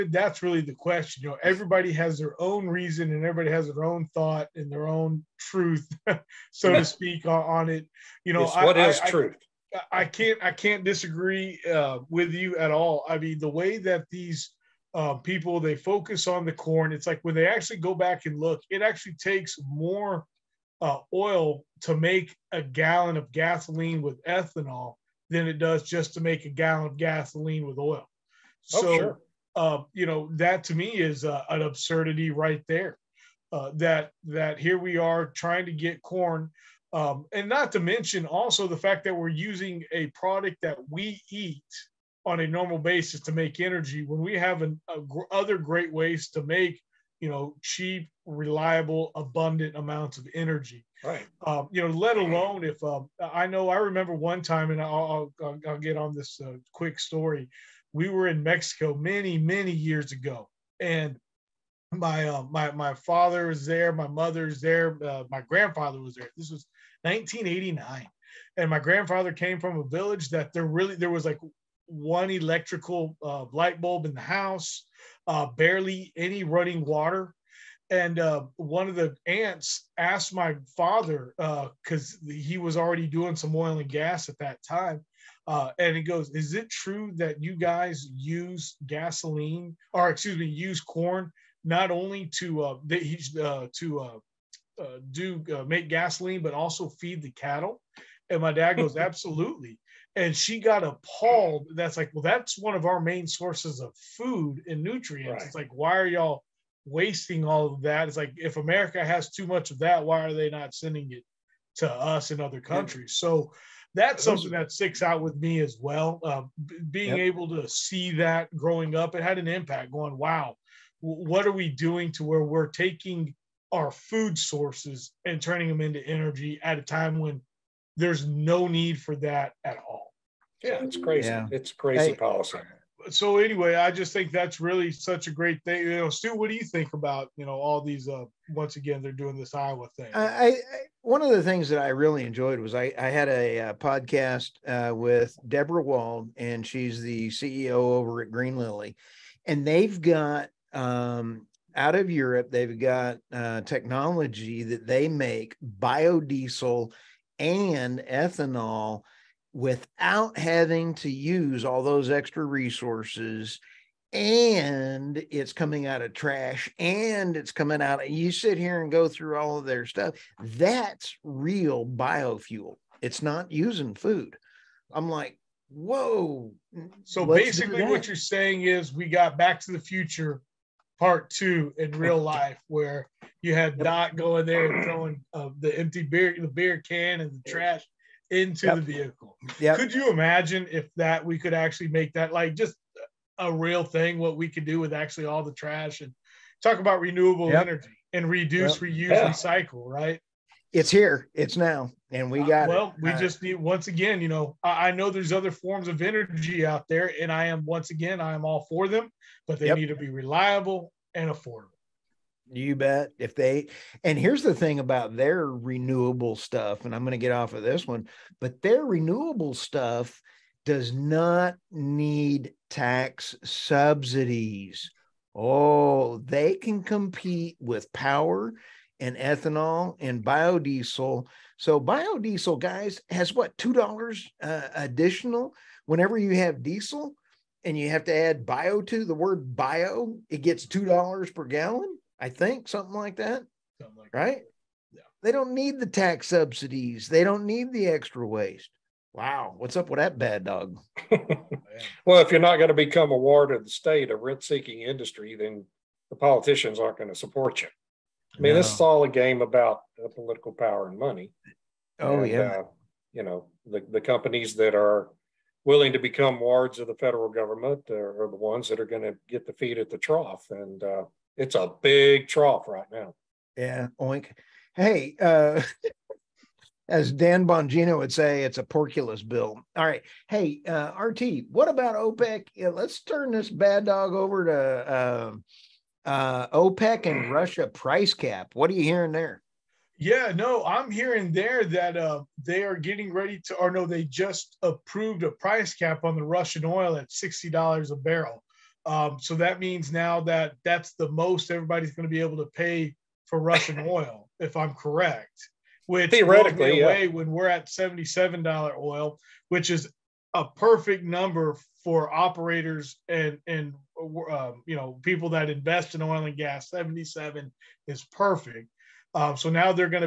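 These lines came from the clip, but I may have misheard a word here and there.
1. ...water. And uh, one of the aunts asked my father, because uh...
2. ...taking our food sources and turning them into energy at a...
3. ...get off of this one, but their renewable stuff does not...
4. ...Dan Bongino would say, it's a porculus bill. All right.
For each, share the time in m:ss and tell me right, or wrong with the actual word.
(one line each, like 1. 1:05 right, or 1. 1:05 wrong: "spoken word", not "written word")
1. 1:16 right
2. 2:02 right
3. 3:37 right
4. 4:37 right.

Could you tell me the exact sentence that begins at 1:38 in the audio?
And my dad goes, Absolutely and she got appalled.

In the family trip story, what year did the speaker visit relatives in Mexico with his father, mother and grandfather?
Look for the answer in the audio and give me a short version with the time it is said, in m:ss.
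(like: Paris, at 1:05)
1989, at 1:07.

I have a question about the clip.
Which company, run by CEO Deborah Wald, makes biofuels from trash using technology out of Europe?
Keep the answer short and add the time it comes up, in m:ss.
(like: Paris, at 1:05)
Green Lily, at 2:28.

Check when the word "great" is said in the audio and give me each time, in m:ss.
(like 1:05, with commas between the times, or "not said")
0:45, 2:15.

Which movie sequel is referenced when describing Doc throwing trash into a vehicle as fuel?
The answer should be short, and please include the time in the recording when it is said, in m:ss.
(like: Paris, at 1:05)
Back to the Future Part 2, at 2:59.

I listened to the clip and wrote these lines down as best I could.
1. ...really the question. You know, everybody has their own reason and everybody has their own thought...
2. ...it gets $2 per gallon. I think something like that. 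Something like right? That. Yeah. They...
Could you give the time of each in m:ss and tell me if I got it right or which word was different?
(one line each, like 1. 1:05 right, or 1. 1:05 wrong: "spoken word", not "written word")
1. 0:00 right
2. 4:00 right.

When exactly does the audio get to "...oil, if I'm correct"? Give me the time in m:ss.
5:03.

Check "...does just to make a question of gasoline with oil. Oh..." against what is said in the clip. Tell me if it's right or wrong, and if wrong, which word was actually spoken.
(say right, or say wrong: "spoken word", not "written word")
wrong: "gallon", not "question".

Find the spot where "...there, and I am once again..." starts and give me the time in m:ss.
3:26.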